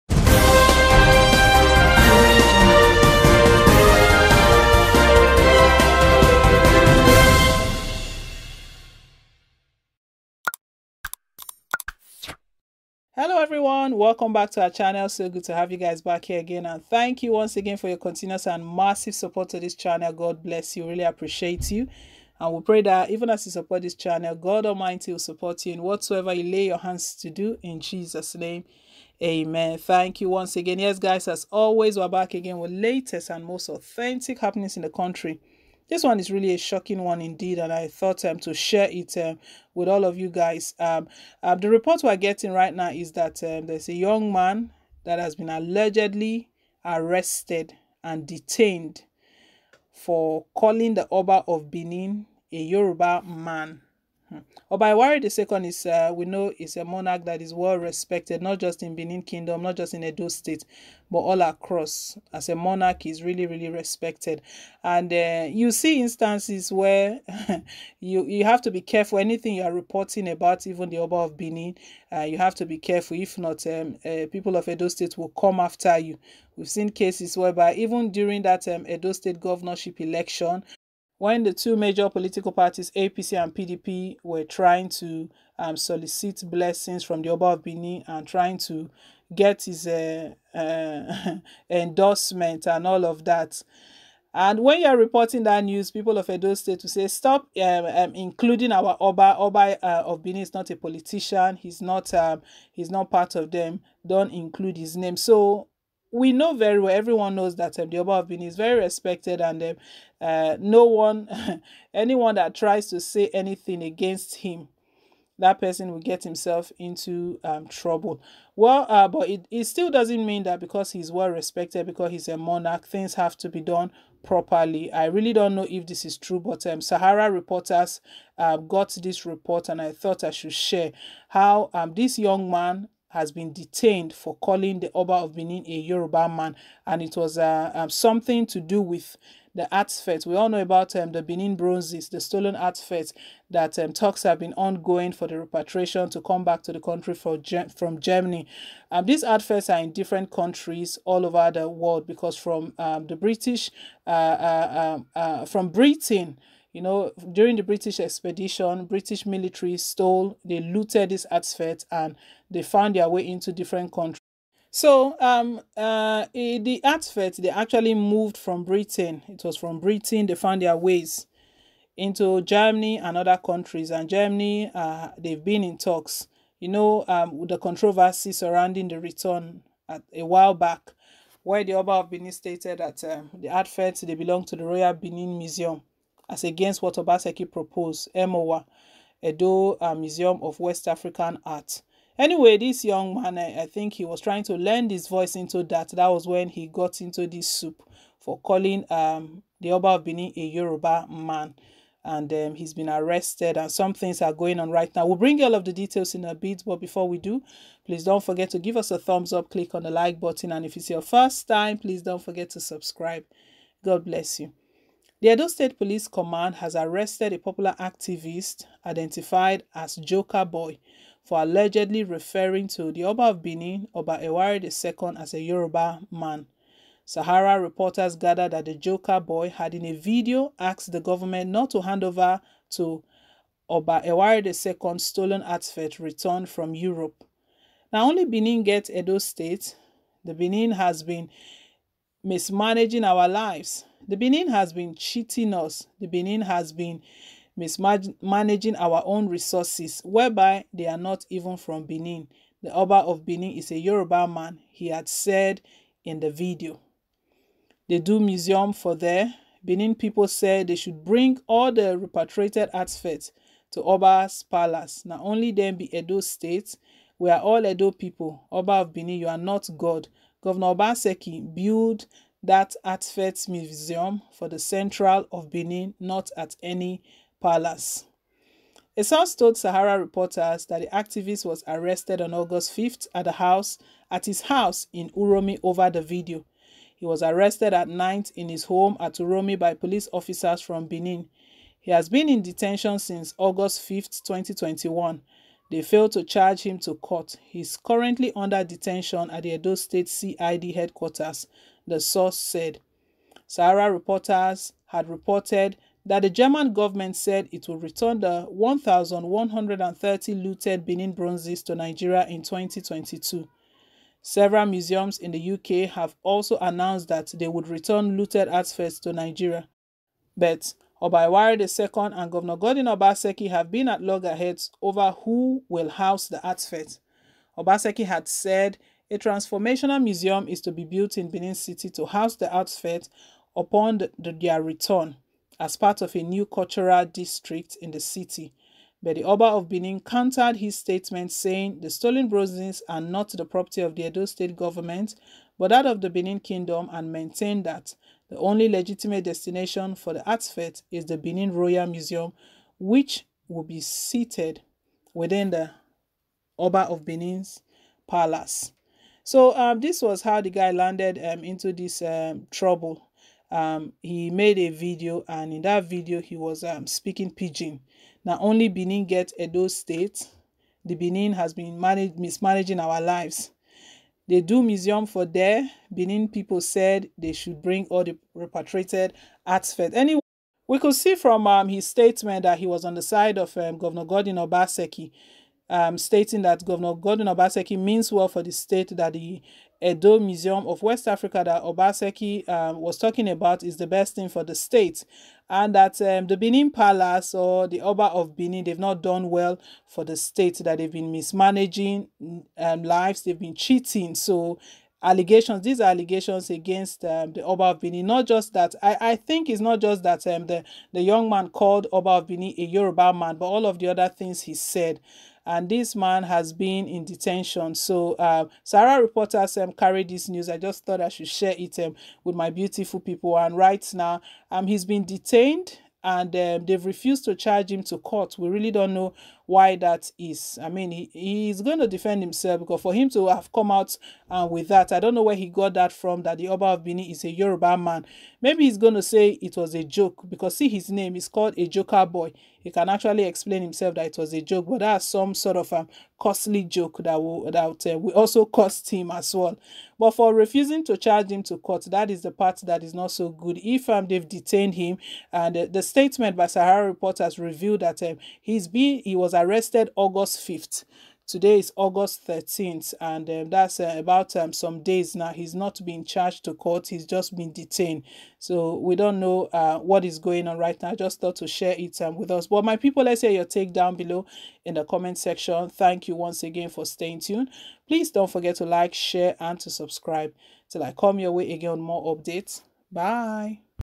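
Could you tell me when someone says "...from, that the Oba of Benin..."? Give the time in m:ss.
7:15.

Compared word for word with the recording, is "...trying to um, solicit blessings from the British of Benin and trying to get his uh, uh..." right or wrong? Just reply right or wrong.
wrong.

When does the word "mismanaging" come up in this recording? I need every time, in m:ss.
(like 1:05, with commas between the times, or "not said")
4:02, 4:07, 6:12, 6:41.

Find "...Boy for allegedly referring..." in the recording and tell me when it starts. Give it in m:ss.
3:40.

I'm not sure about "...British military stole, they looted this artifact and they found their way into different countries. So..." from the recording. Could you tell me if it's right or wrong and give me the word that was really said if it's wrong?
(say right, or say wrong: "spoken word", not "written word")
right.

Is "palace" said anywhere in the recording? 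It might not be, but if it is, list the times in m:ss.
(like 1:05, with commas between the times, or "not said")
4:24, 4:37, 5:58, 6:36.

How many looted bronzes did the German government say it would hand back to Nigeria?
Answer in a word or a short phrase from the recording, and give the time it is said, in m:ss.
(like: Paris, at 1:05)
1,130, at 5:08.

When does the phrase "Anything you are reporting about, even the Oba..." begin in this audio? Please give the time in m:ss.
1:09.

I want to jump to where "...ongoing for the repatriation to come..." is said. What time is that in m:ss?
2:24.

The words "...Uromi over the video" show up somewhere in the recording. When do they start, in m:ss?
4:45.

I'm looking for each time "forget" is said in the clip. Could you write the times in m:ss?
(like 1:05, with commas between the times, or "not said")
3:28, 3:32, 7:58.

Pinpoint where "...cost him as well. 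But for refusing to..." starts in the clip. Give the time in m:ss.
7:28.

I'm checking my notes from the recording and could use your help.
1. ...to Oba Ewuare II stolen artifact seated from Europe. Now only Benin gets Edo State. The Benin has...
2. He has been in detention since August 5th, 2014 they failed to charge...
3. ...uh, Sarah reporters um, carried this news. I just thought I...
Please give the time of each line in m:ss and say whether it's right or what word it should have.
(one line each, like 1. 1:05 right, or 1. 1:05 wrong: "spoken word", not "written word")
1. 3:52 wrong: "returned", not "seated"
2. 4:51 wrong: "2021", not "2014"
3. 6:58 right.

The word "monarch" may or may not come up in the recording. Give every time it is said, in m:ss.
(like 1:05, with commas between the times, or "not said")
0:56, 1:02, 2:02.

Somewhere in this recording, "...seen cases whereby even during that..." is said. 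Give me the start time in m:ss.
1:16.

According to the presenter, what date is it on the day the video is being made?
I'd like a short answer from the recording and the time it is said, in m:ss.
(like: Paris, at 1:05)
August 13th, at 7:41.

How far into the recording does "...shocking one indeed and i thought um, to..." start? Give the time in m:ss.
0:36.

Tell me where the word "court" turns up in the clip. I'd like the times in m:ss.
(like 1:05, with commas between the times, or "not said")
4:56, 7:07, 7:31, 7:46.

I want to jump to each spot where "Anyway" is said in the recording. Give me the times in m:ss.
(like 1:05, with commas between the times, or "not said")
3:12, 6:19.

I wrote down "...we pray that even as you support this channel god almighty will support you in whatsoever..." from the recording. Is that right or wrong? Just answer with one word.
right.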